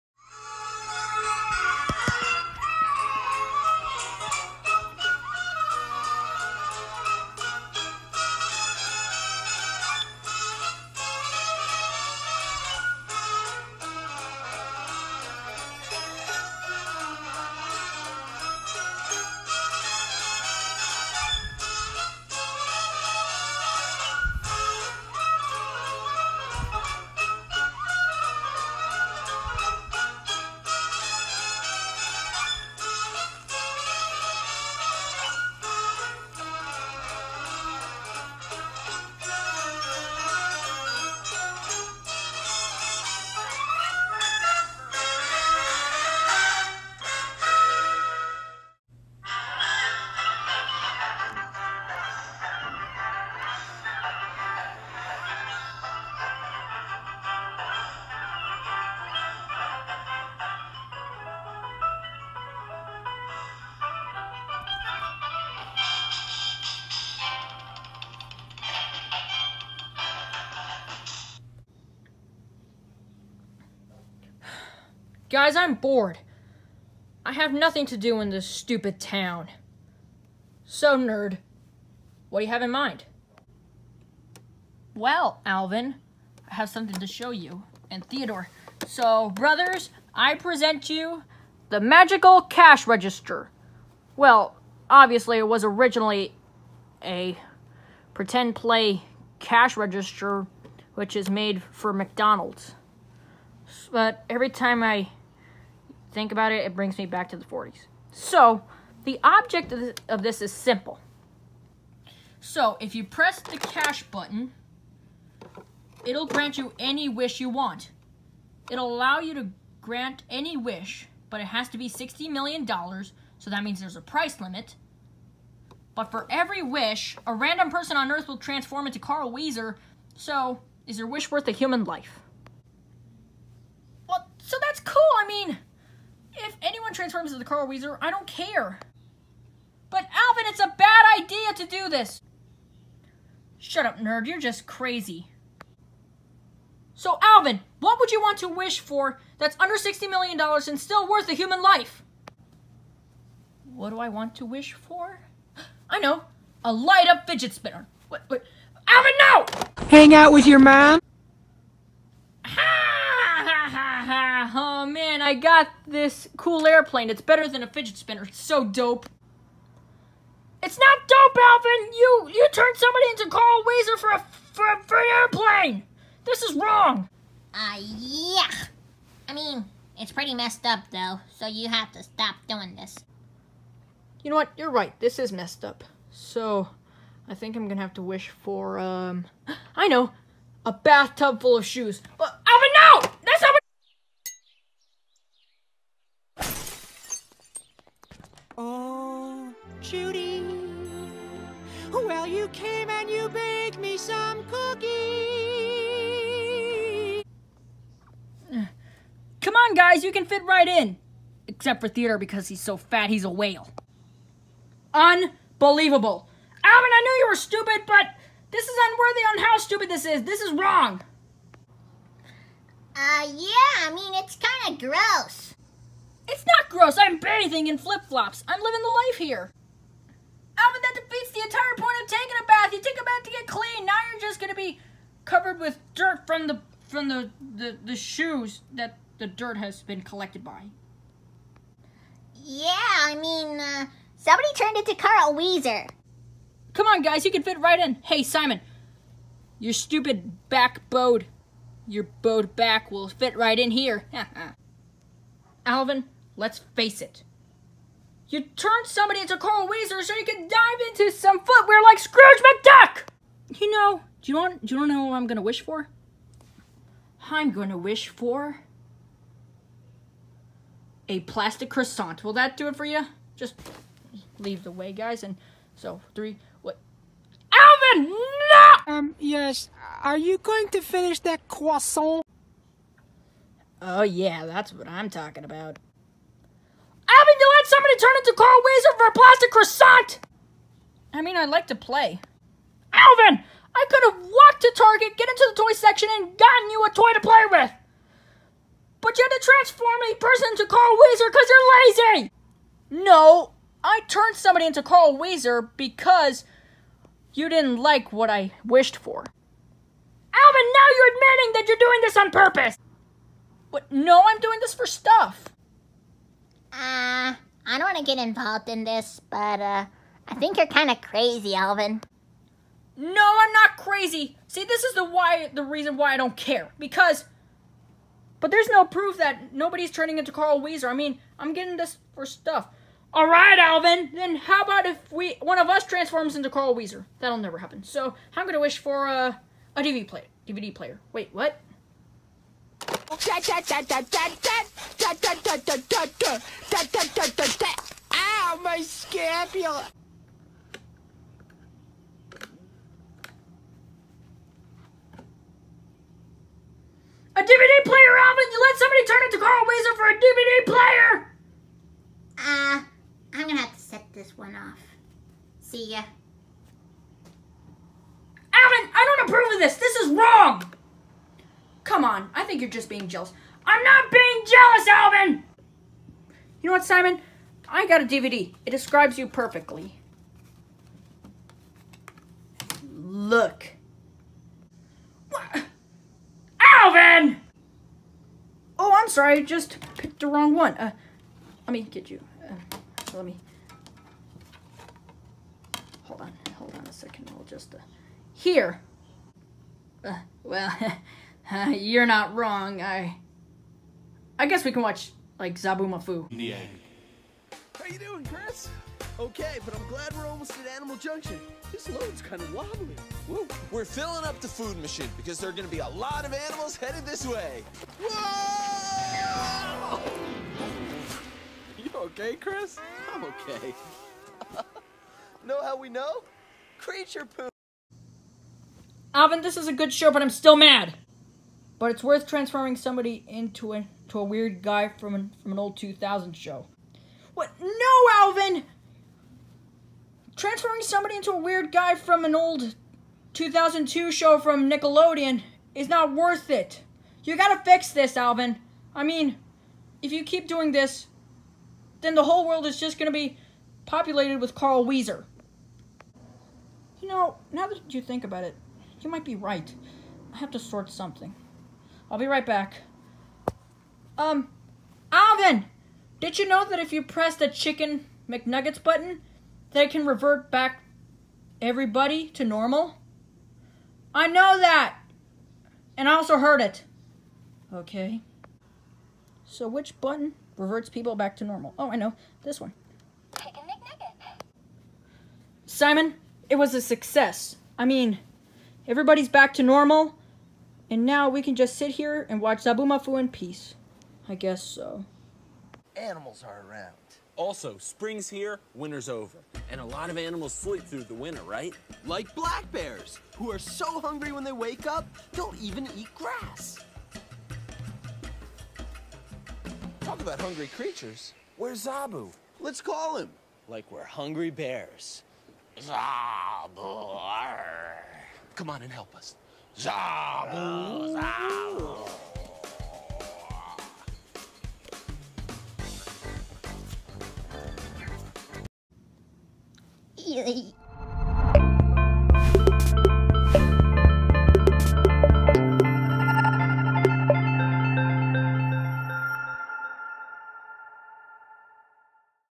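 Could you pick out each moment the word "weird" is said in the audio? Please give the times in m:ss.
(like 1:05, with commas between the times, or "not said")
7:14, 7:21.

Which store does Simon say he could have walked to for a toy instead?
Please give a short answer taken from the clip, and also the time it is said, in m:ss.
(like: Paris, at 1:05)
Target, at 4:54.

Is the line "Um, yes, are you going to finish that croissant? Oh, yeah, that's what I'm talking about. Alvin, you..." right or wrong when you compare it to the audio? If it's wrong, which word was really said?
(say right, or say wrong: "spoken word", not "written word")
right.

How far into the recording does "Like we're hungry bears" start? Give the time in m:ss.
8:33.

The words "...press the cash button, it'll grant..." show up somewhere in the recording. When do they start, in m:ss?
1:53.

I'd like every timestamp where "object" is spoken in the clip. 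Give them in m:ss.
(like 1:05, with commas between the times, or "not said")
1:49.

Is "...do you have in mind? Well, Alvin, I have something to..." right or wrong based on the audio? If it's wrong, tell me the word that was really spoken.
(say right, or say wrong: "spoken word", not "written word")
right.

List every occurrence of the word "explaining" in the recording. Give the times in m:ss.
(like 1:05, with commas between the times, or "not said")
not said.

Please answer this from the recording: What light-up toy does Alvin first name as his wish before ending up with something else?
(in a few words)
A light up fidget spinner.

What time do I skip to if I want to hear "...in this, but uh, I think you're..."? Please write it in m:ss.
5:18.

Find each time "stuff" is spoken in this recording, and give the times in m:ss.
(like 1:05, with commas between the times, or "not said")
5:14, 5:32.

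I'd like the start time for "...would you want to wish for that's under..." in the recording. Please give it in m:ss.
2:27.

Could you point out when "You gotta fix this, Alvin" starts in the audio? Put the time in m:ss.
7:27.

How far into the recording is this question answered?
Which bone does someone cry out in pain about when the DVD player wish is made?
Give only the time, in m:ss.
5:48.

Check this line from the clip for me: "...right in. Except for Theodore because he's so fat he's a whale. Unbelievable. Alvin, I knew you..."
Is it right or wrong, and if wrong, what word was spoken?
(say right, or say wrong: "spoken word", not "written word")
right.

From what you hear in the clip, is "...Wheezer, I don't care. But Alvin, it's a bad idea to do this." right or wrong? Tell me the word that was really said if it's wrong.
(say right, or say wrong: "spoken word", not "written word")
right.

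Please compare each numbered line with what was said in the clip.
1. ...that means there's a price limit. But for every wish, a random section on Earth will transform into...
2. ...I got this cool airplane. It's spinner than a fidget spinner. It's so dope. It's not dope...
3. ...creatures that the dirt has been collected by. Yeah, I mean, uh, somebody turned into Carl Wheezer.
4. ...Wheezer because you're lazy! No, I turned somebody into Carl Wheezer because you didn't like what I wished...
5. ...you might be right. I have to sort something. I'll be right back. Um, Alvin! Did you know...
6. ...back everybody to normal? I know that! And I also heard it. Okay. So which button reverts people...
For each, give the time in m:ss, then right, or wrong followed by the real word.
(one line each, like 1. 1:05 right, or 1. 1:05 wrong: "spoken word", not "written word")
1. 2:03 wrong: "person", not "section"
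2. 2:45 wrong: "better", not "spinner"
3. 3:57 wrong: "shoes", not "creatures"
4. 5:00 right
5. 7:39 right
6. 7:50 right.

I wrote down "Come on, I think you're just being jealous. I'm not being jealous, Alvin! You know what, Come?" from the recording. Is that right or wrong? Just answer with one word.
wrong.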